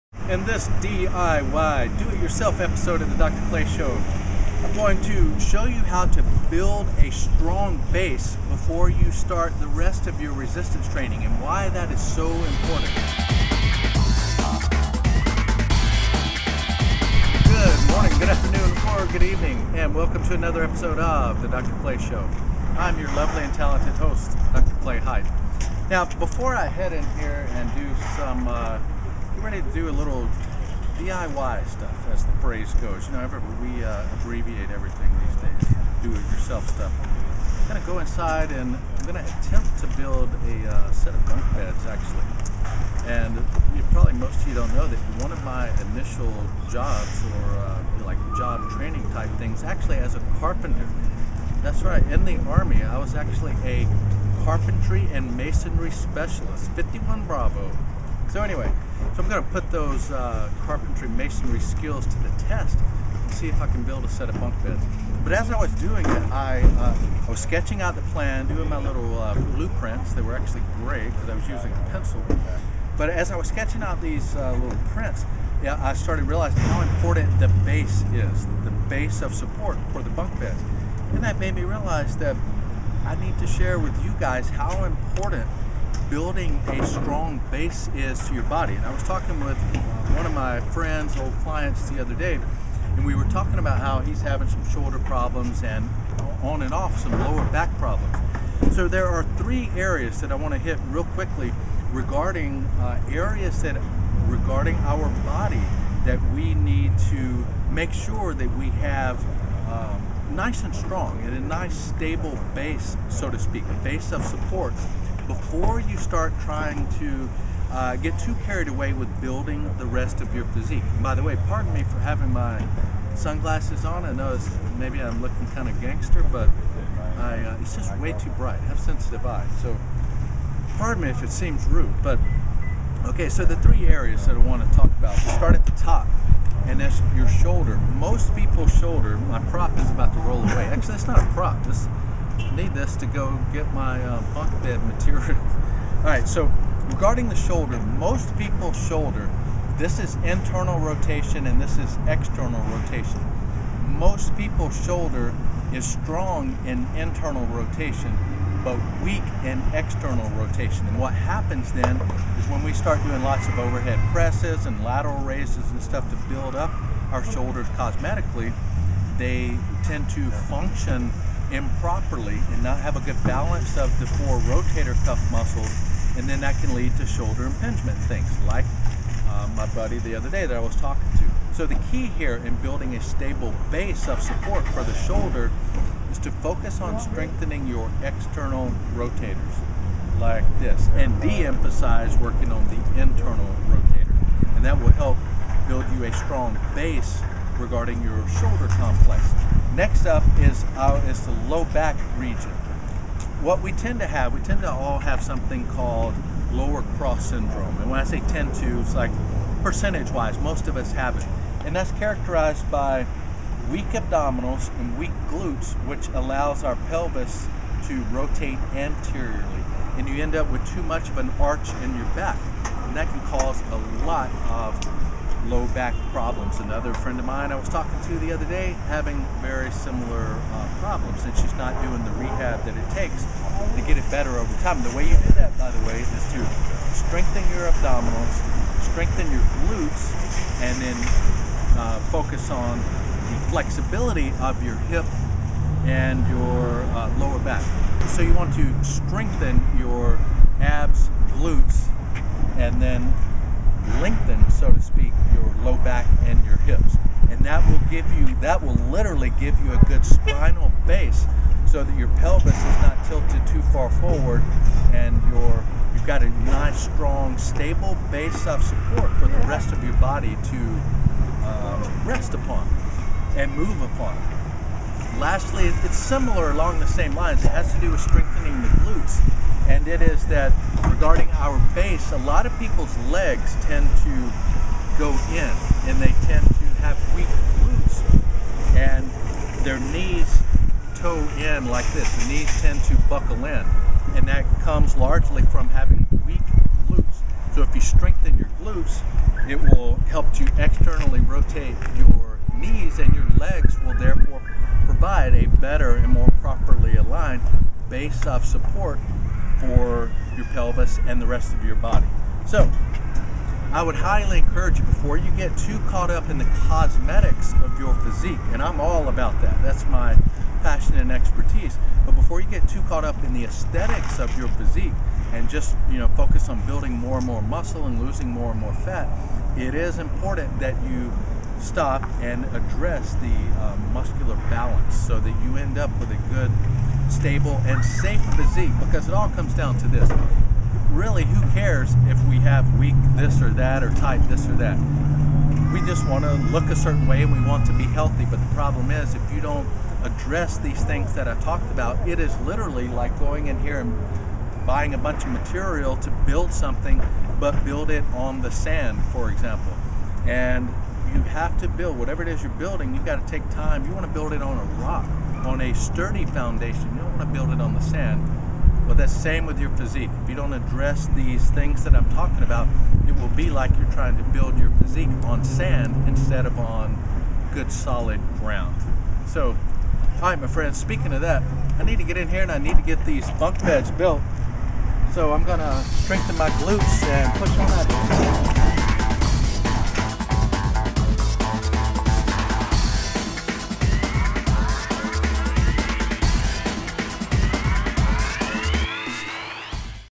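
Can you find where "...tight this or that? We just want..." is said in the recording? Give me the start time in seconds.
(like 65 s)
343 s.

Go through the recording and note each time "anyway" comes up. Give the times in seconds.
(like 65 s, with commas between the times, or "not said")
58 s.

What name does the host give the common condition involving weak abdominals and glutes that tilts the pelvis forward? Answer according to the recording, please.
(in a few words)
lower cross syndrome.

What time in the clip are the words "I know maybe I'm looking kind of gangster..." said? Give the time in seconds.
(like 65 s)
124 s.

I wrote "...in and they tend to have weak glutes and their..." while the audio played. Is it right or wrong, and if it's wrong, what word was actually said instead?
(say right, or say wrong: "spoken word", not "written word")
right.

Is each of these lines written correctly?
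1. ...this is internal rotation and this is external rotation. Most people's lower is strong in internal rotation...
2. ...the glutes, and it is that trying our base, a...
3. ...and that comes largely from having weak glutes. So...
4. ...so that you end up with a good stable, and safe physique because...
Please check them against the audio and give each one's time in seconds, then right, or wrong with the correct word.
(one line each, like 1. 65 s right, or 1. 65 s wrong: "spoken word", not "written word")
1. 149 s wrong: "shoulder", not "lower"
2. 278 s wrong: "regarding", not "trying"
3. 294 s right
4. 334 s right.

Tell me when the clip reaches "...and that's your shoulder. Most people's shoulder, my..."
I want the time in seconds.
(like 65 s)
136 s.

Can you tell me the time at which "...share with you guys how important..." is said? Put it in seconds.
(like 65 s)
83 s.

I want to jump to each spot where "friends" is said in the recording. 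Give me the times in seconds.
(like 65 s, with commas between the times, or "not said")
90 s, 226 s, 380 s.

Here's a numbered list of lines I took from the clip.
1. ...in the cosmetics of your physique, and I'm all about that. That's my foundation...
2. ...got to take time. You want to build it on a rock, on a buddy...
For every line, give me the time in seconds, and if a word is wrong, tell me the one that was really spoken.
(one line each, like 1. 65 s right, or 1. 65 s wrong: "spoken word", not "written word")
1. 316 s wrong: "passion", not "foundation"
2. 363 s wrong: "sturdy", not "buddy".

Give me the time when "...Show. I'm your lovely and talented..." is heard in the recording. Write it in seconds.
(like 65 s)
21 s.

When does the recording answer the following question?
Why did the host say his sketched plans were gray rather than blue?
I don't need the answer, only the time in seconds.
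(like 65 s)
71 s.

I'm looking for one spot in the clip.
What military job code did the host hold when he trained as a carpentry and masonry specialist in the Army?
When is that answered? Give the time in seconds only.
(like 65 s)
56 s.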